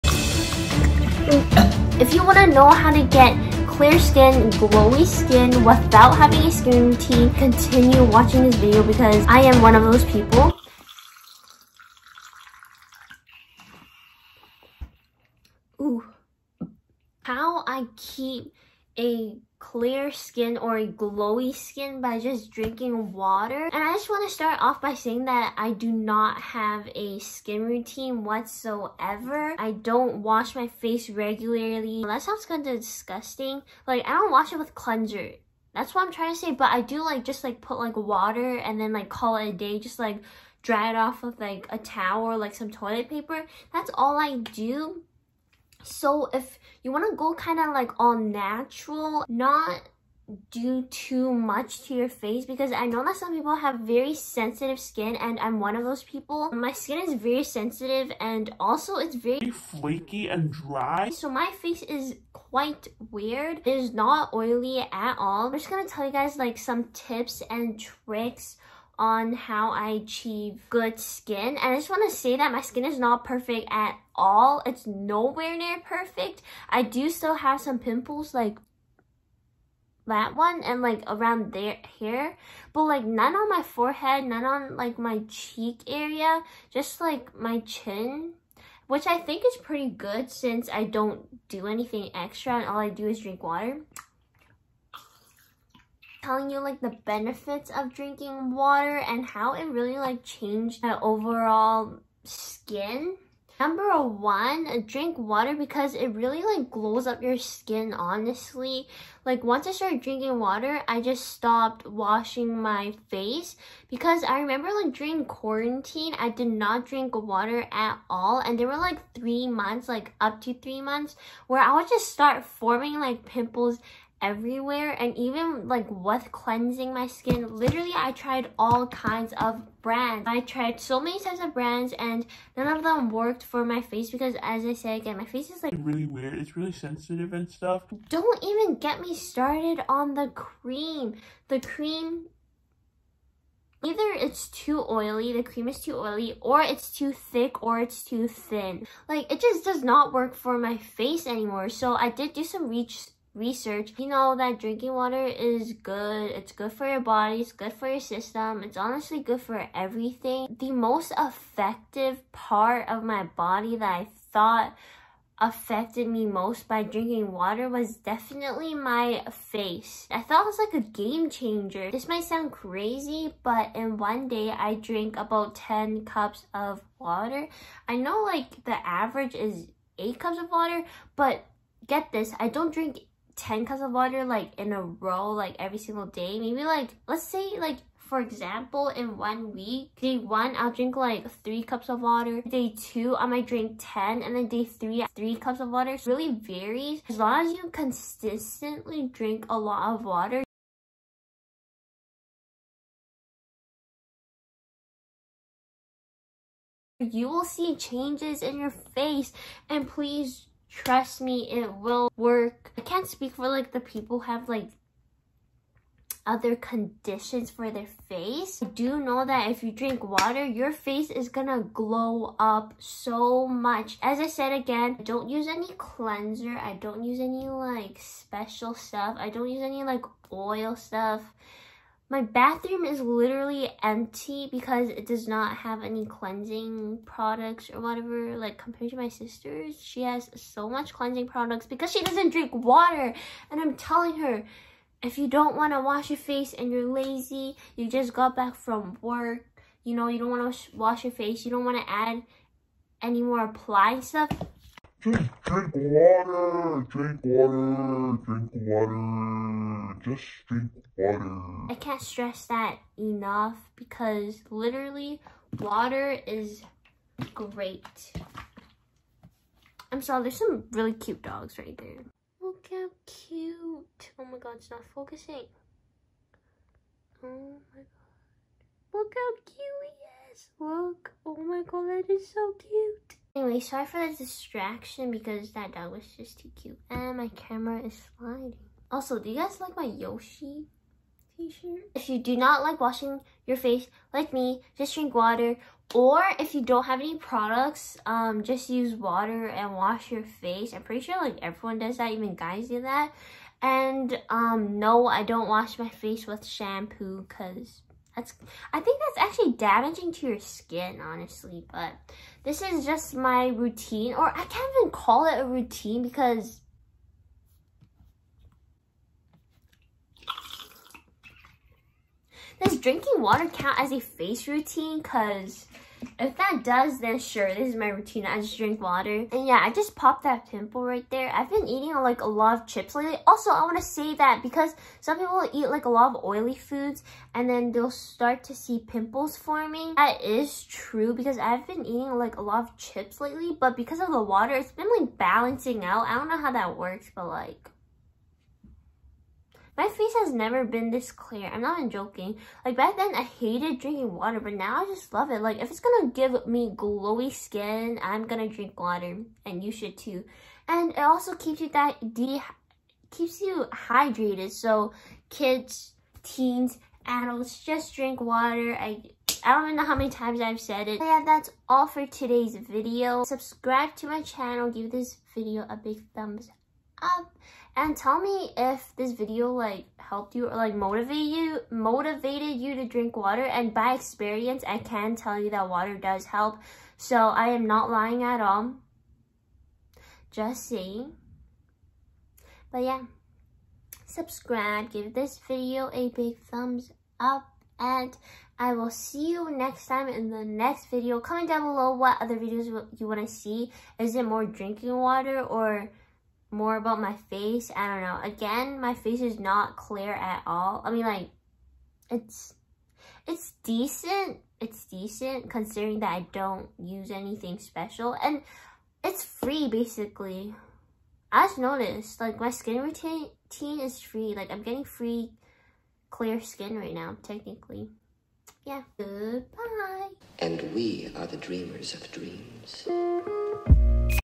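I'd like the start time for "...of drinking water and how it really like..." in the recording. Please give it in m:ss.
1:37.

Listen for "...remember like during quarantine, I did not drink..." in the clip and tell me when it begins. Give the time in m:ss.
1:54.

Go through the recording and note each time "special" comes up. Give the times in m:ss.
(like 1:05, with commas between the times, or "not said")
3:47, 6:57.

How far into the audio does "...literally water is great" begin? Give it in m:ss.
4:24.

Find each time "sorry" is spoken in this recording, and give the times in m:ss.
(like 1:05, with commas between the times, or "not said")
4:30, 4:43.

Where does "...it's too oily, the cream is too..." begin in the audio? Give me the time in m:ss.
2:24.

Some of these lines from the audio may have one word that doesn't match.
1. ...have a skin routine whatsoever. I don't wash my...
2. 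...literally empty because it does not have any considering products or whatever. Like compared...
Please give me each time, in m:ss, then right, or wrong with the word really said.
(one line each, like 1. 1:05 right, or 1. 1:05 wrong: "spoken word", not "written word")
1. 0:26 right
2. 3:52 wrong: "cleansing", not "considering".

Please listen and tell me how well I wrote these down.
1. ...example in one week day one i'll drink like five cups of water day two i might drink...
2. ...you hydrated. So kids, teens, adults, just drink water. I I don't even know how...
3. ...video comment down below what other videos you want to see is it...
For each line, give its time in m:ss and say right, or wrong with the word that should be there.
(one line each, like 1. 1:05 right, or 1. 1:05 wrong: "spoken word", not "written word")
1. 3:08 wrong: "three", not "five"
2. 6:03 right
3. 6:40 right.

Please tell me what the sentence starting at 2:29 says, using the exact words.
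Like, it just does not work for my face anymore.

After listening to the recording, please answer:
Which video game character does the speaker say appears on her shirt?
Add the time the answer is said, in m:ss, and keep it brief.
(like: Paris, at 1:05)
Yoshi, at 4:49.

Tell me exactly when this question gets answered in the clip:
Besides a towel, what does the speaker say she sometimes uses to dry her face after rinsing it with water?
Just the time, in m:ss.
0:42.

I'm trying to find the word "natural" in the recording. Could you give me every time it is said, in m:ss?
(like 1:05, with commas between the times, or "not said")
0:48.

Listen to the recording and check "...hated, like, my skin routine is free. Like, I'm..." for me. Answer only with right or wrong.
wrong.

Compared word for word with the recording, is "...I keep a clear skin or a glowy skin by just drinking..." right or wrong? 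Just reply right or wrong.
right.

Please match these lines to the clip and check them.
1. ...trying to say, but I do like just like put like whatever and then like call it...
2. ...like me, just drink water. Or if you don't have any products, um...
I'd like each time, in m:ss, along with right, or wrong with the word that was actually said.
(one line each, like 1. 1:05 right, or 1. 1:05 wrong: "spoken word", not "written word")
1. 0:36 wrong: "water", not "whatever"
2. 4:54 right.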